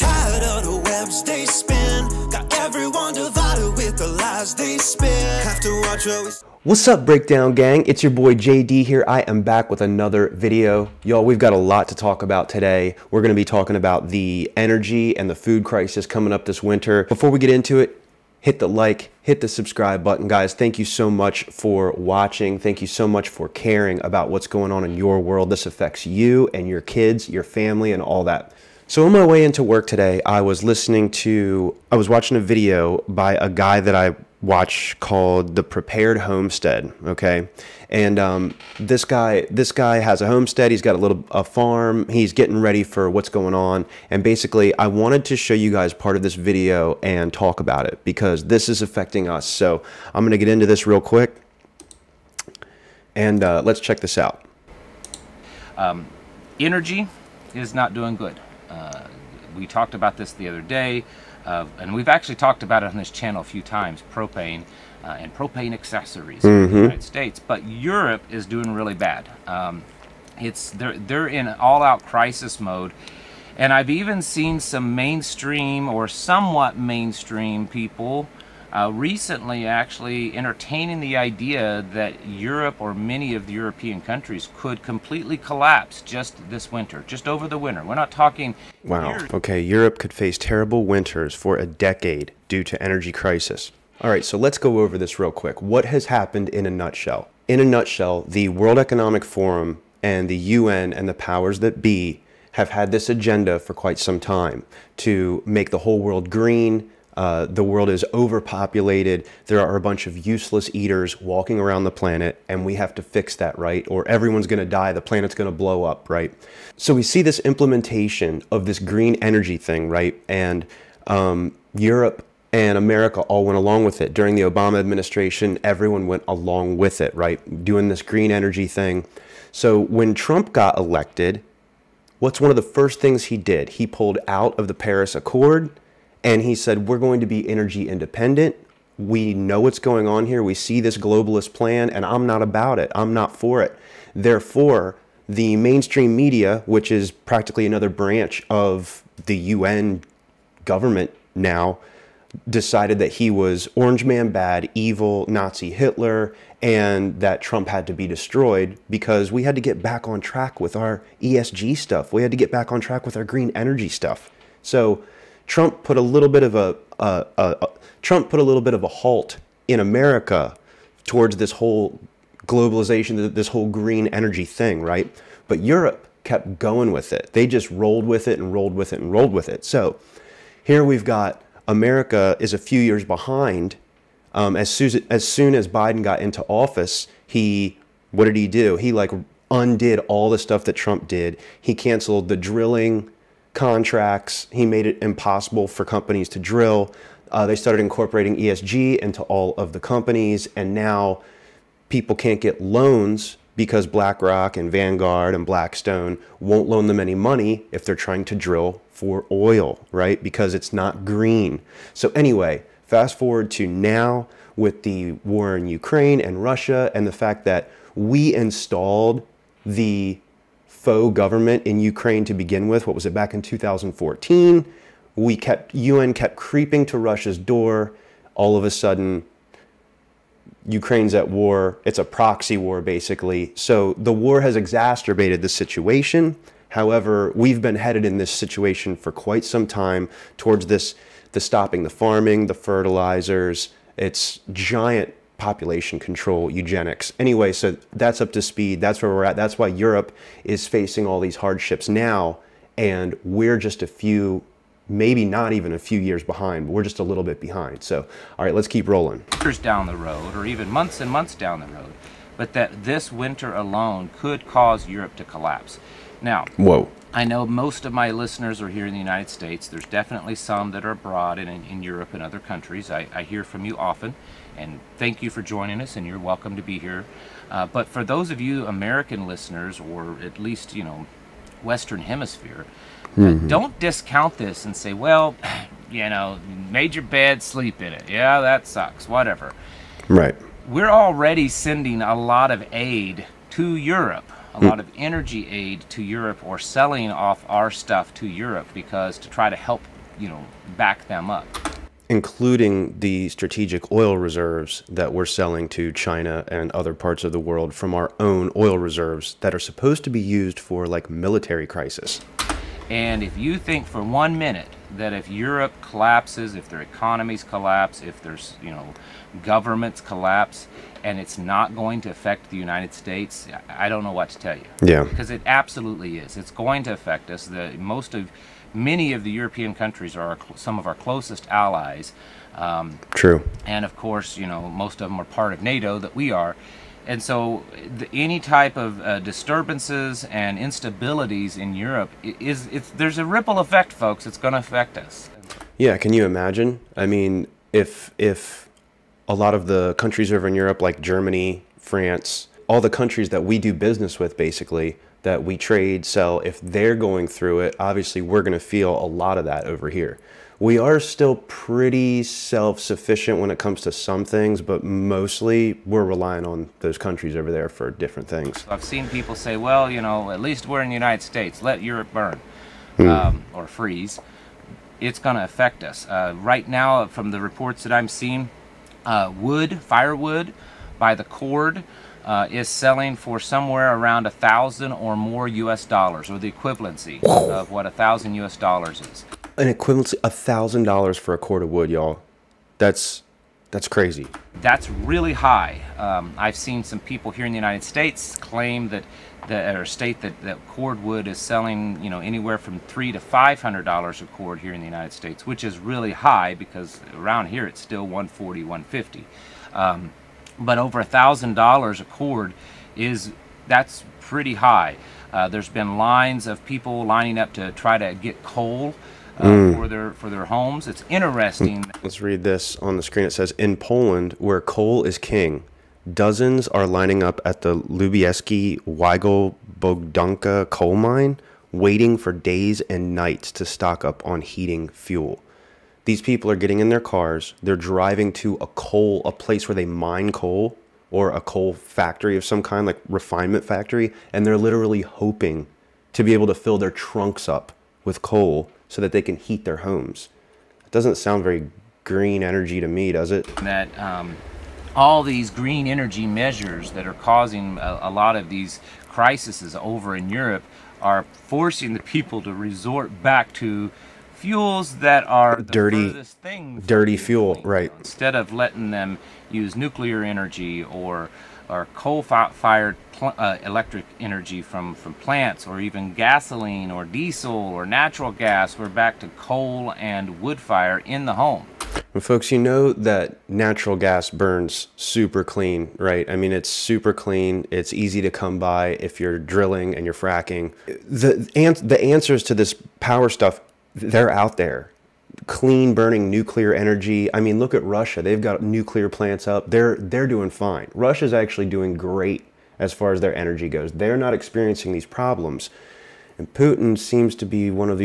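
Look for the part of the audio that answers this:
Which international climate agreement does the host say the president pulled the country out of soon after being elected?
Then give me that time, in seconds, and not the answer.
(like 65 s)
134 s.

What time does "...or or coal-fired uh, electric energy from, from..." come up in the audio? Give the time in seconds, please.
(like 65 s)
470 s.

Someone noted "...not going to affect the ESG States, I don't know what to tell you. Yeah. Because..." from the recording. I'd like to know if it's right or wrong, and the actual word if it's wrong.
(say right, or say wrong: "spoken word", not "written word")
wrong: "United", not "ESG".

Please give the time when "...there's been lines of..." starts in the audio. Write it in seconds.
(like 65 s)
415 s.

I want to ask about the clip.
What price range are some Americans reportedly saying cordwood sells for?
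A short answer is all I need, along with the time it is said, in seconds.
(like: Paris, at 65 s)
$300 to $500, at 402 s.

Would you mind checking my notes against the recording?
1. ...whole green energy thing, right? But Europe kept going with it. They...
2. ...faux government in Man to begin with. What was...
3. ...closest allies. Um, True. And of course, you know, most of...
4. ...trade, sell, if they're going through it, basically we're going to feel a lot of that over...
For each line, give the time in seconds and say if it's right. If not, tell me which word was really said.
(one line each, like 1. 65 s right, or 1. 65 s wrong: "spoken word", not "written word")
1. 173 s right
2. 220 s wrong: "Ukraine", not "Man"
3. 330 s right
4. 355 s wrong: "obviously", not "basically".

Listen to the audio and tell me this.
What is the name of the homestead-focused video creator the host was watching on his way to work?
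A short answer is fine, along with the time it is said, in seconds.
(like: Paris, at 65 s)
Prepared Homestead, at 35 s.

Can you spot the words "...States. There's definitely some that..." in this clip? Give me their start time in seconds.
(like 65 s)
269 s.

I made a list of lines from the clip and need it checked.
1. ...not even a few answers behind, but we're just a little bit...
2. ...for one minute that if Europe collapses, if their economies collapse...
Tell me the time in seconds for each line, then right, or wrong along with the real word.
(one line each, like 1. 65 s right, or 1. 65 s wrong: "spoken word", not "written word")
1. 255 s wrong: "years", not "answers"
2. 313 s right.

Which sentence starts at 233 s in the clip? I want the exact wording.
So the war has exacerbated the situation.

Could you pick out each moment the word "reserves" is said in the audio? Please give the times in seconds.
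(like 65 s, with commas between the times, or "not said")
304 s, 308 s.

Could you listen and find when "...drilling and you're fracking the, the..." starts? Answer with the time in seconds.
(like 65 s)
489 s.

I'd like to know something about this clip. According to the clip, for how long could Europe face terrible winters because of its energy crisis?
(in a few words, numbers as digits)
a decade.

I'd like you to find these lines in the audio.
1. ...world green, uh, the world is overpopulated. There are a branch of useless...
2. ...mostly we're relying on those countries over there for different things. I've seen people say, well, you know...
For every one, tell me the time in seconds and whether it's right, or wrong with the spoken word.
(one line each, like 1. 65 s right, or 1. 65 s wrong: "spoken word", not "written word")
1. 105 s wrong: "bunch", not "branch"
2. 364 s right.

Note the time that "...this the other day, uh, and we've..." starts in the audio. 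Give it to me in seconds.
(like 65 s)
60 s.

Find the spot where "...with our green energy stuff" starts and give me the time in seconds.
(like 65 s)
163 s.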